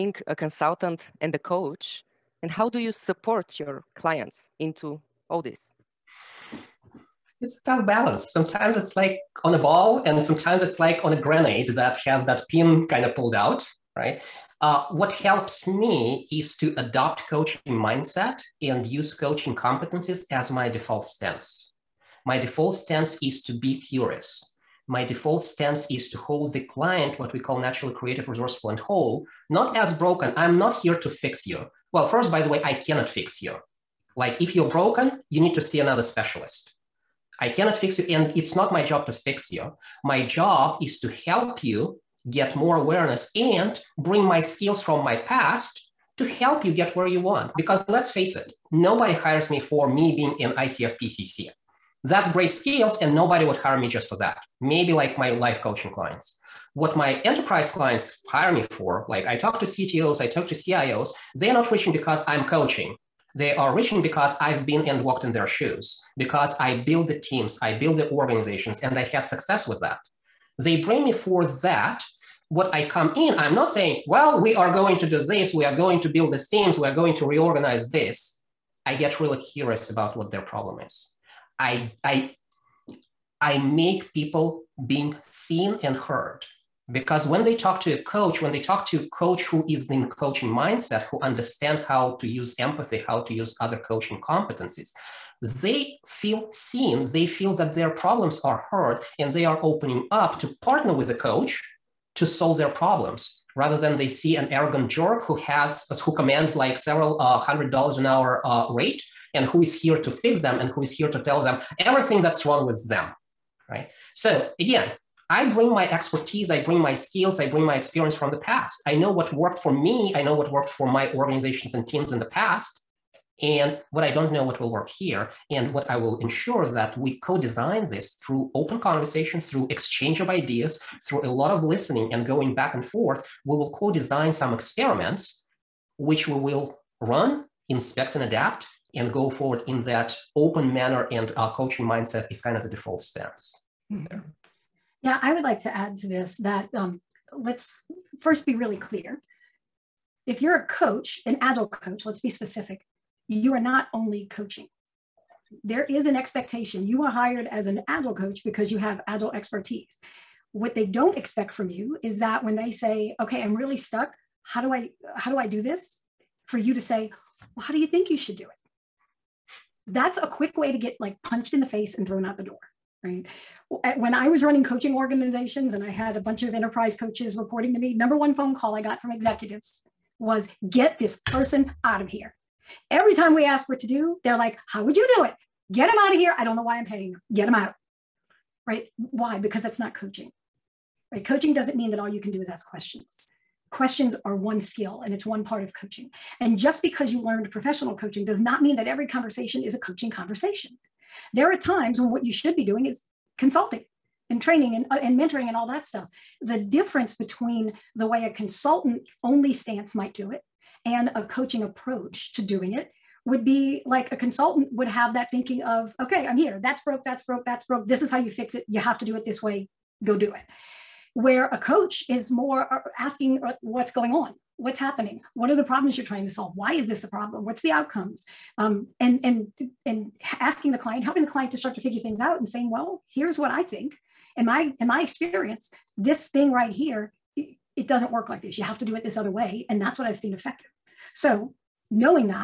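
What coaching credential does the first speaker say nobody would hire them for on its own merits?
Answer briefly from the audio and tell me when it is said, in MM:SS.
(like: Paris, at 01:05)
ICF PCC, at 00:50.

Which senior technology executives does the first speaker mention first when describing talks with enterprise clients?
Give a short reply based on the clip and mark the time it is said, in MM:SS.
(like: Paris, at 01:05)
CTOs, at 00:59.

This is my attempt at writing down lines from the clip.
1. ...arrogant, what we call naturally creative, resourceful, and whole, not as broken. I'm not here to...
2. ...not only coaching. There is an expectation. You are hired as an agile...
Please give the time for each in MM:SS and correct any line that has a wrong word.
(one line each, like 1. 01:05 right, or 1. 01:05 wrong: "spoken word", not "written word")
1. 00:26 wrong: "client", not "arrogant"
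2. 02:33 right.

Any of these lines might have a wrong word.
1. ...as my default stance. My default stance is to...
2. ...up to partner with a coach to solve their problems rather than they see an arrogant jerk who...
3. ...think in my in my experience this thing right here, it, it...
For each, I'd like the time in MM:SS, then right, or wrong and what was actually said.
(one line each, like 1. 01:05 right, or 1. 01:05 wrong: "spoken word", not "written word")
1. 00:20 right
2. 01:40 right
3. 03:53 right.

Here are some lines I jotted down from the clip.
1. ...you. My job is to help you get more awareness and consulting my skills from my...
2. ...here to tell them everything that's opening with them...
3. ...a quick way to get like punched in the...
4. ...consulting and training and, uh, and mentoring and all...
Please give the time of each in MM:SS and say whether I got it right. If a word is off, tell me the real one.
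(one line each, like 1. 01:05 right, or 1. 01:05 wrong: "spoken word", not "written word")
1. 00:39 wrong: "bring", not "consulting"
2. 01:50 wrong: "wrong", not "opening"
3. 02:50 right
4. 03:23 right.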